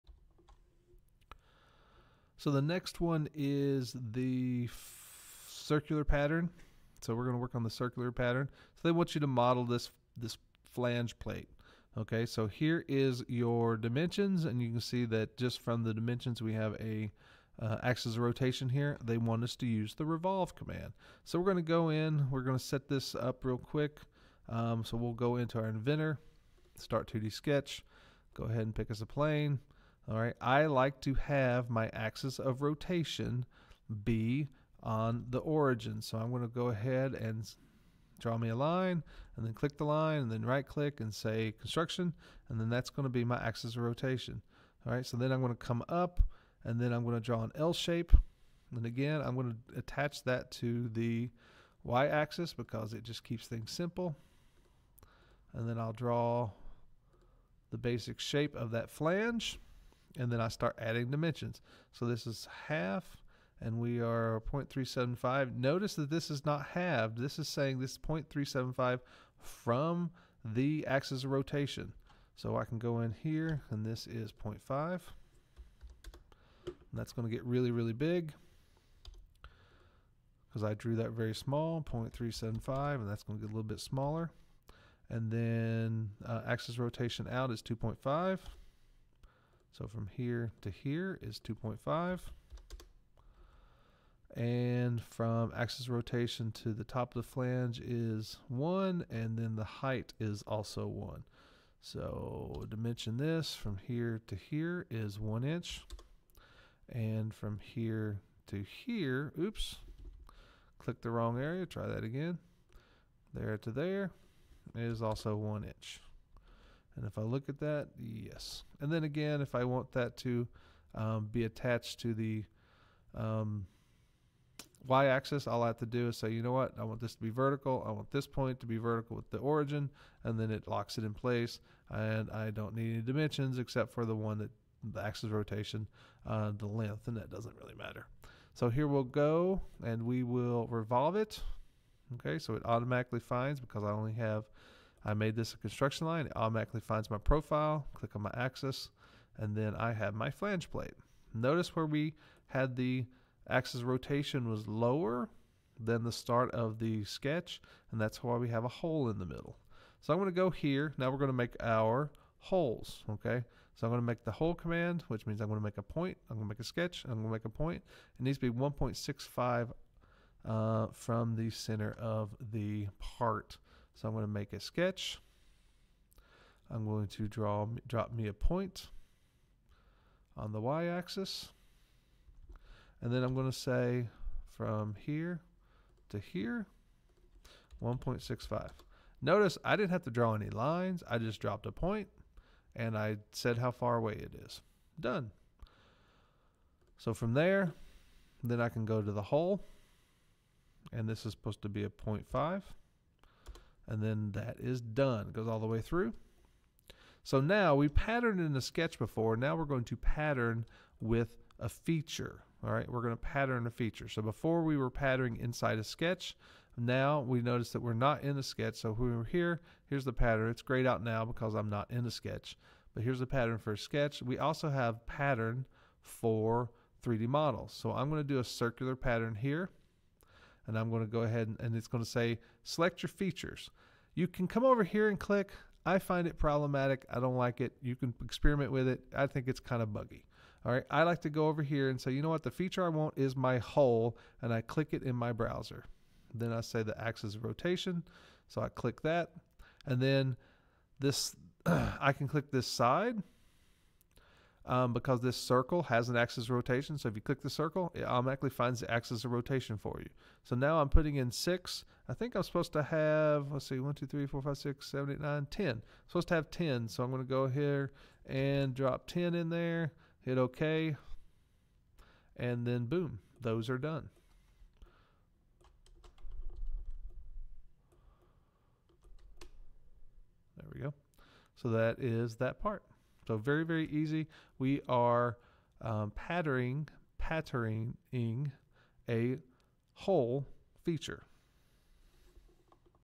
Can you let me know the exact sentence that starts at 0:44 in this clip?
All right, so then I'm going to come up and then I'm going to draw an L shape.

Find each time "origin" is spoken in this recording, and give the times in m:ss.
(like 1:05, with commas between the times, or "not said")
0:35, 2:09.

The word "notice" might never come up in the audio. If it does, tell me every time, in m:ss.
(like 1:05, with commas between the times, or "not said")
1:05, 2:31, 3:09, 3:37.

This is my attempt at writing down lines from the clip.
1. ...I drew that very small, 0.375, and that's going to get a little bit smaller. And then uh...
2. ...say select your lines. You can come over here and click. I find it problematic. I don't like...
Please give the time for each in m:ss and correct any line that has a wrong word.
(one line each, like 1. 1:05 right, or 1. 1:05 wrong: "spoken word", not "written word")
1. 1:20 right
2. 3:52 wrong: "features", not "lines".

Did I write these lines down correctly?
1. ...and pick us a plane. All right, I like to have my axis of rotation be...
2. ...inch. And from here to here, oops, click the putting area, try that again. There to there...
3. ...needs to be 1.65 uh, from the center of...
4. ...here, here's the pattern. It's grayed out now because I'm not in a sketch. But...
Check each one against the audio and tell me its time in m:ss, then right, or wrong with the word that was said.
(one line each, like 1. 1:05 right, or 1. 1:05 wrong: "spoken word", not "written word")
1. 0:28 right
2. 1:45 wrong: "wrong", not "putting"
3. 2:48 right
4. 3:39 right.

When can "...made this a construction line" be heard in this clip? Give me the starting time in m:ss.
2:25.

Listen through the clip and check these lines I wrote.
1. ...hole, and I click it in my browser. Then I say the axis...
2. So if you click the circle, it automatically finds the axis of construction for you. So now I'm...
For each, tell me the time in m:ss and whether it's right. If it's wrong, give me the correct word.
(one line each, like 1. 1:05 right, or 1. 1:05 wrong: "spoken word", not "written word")
1. 4:03 right
2. 4:16 wrong: "rotation", not "construction".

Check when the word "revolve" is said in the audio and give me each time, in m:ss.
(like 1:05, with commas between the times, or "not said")
0:20, 2:20.